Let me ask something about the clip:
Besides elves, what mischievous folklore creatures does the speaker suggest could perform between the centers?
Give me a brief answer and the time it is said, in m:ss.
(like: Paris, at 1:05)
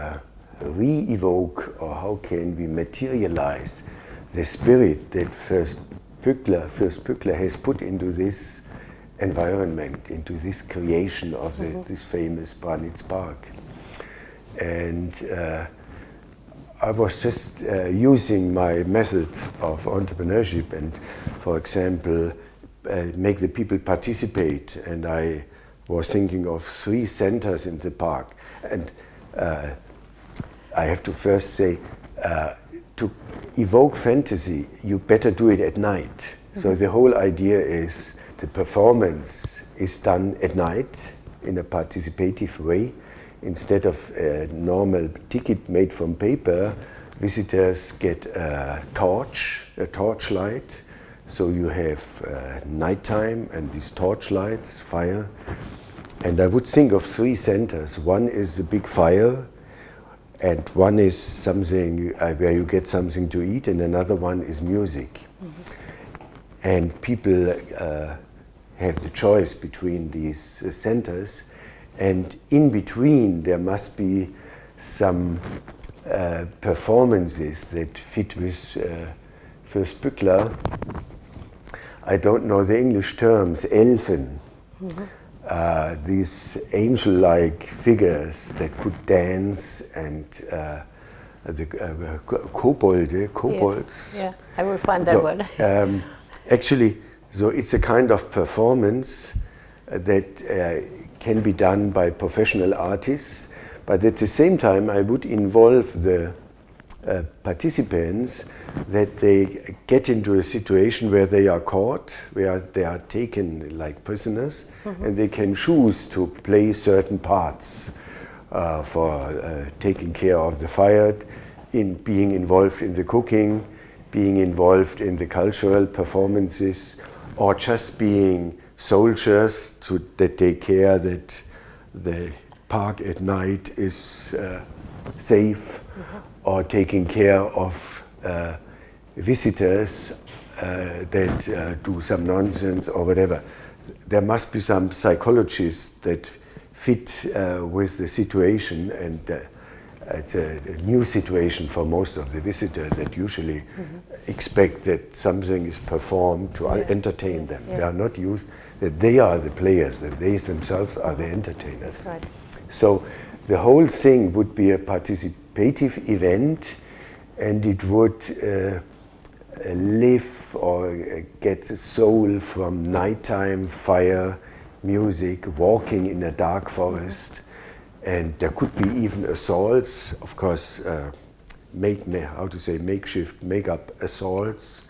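Kobolds, at 1:33.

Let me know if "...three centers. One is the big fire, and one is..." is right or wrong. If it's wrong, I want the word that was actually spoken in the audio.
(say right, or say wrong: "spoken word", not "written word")
right.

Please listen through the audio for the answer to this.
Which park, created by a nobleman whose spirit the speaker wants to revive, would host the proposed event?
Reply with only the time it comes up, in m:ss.
0:12.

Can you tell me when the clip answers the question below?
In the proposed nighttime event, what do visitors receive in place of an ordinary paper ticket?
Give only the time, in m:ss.
0:48.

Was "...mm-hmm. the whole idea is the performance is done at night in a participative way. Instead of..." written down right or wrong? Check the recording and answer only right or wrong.
right.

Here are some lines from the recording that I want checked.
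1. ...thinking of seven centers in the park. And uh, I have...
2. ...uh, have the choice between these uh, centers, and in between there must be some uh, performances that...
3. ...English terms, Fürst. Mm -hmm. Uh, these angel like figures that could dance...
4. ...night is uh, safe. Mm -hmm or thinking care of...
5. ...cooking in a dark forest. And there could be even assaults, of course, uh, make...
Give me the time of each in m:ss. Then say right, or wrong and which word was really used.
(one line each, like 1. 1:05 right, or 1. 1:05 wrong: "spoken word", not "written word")
1. 0:26 wrong: "three", not "seven"
2. 1:07 right
3. 1:22 wrong: "Elfen", not "Fürst"
4. 2:13 wrong: "taking", not "thinking"
5. 2:55 wrong: "walking", not "cooking".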